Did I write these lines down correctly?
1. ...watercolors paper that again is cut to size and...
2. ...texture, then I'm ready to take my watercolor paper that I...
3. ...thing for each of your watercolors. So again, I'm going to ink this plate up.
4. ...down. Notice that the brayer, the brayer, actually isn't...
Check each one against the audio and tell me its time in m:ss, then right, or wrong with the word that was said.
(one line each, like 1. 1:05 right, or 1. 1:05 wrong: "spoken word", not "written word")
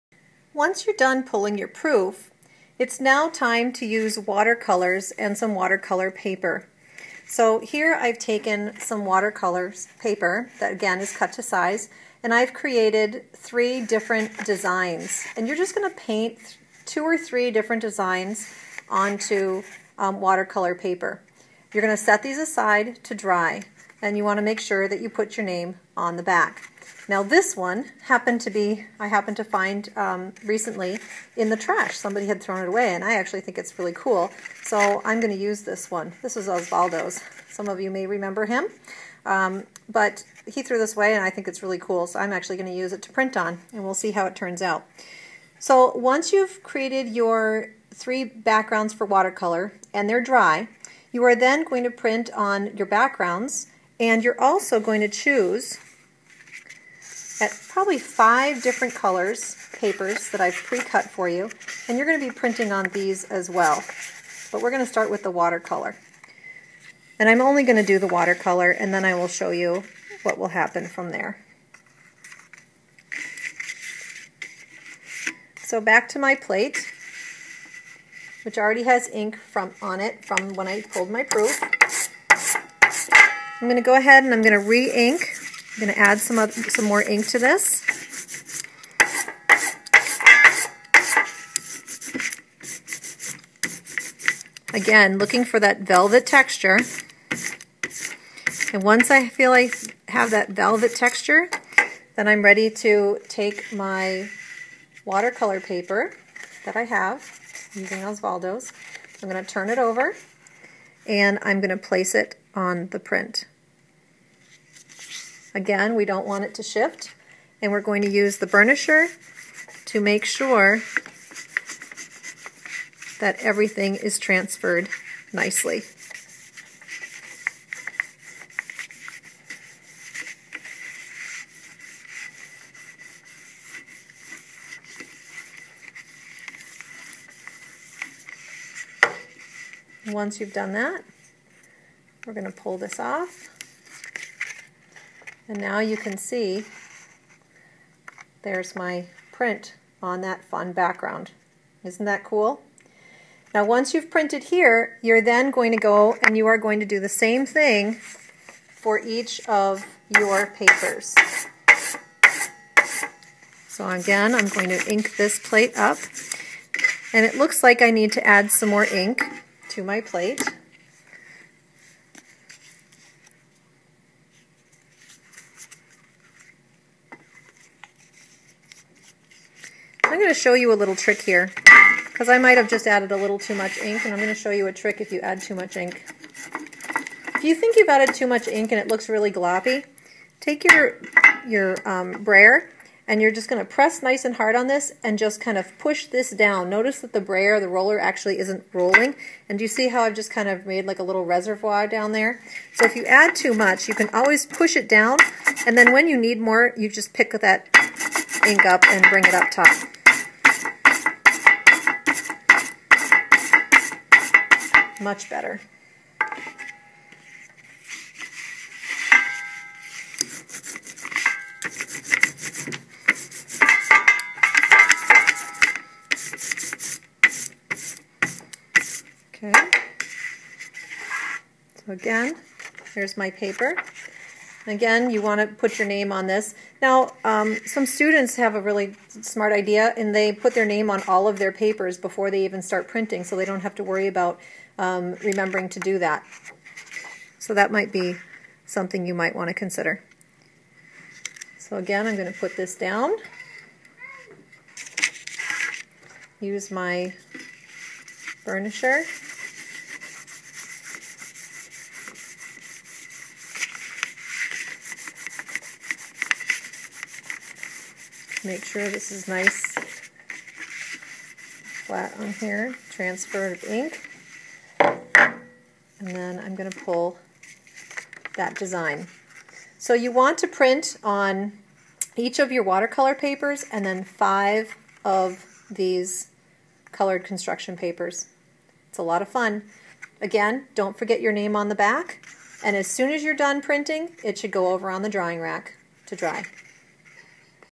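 1. 0:09 right
2. 1:40 right
3. 2:37 wrong: "papers", not "watercolors"
4. 3:16 wrong: "roller", not "brayer".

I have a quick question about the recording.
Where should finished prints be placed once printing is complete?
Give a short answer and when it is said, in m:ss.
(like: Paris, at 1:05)
the drying rack, at 4:55.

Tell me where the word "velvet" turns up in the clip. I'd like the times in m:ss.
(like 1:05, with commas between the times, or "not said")
1:35, 1:40.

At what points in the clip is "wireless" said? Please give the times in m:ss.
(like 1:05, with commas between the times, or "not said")
not said.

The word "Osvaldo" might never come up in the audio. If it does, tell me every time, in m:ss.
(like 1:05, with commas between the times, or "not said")
0:36, 1:48.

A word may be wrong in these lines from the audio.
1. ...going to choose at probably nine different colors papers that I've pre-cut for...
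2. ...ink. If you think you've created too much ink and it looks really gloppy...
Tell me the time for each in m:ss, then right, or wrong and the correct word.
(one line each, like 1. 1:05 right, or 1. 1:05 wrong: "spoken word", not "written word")
1. 0:54 wrong: "five", not "nine"
2. 3:05 wrong: "added", not "created".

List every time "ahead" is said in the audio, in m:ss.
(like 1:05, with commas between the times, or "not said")
1:23.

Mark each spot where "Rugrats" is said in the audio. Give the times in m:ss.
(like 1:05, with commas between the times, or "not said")
not said.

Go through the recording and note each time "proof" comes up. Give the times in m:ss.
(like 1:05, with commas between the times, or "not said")
0:01, 1:21.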